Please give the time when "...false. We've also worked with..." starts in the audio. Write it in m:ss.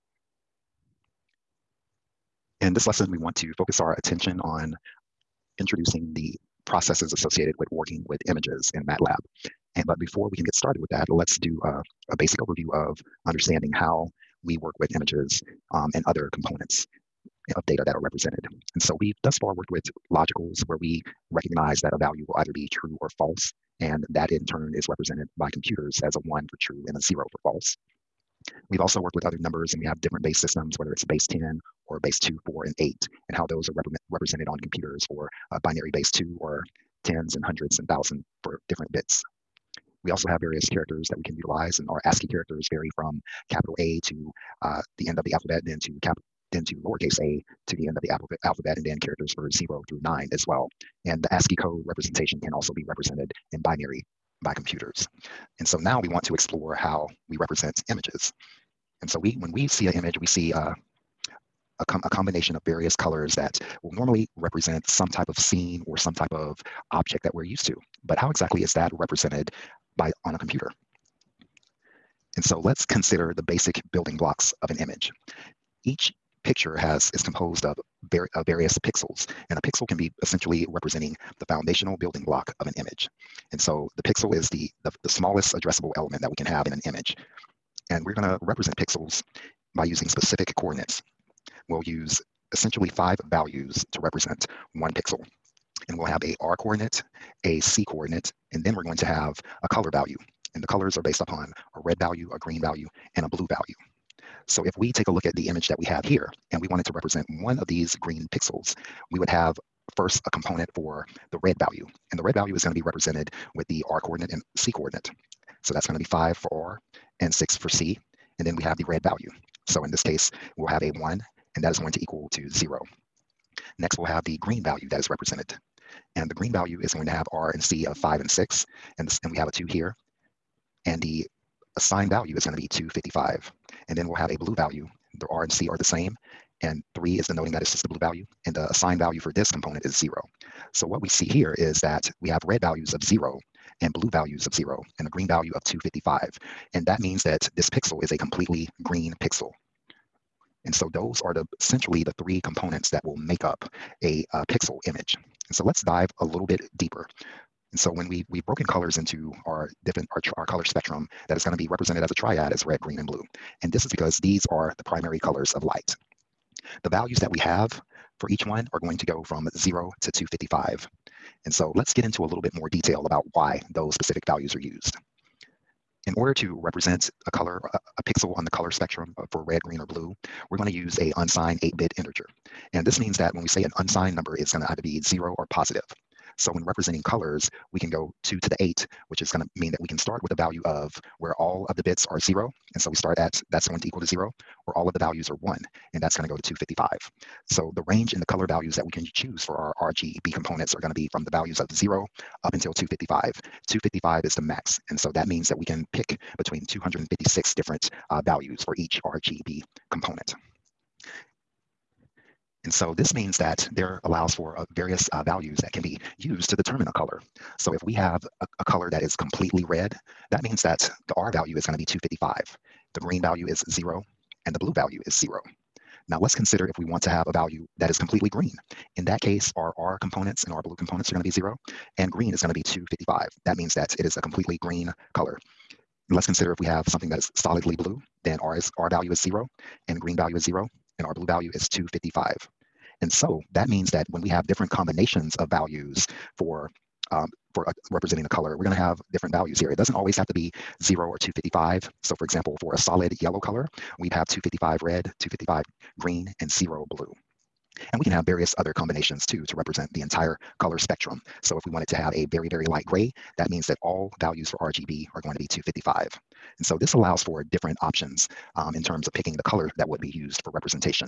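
0:27.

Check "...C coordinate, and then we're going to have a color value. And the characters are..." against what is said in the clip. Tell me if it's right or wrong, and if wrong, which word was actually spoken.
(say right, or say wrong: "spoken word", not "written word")
wrong: "colors", not "characters".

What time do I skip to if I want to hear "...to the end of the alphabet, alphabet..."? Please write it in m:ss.
0:47.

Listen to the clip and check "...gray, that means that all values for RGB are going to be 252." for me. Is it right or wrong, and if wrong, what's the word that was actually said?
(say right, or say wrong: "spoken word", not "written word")
wrong: "255", not "252".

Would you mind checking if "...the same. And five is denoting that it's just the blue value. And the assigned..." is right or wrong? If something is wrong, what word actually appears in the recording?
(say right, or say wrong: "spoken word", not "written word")
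wrong: "three", not "five".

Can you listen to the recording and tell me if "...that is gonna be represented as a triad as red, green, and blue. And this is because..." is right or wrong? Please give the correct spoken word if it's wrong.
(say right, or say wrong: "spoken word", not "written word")
right.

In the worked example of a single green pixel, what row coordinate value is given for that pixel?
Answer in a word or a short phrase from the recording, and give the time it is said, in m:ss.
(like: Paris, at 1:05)
5, at 1:56.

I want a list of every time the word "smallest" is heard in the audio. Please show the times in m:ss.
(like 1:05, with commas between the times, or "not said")
1:25.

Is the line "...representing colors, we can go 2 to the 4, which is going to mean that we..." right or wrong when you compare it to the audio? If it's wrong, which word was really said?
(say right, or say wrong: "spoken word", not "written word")
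wrong: "8", not "4".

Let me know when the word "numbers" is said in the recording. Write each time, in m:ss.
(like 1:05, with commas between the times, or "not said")
0:29, 3:04.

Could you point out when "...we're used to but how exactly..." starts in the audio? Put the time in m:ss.
1:07.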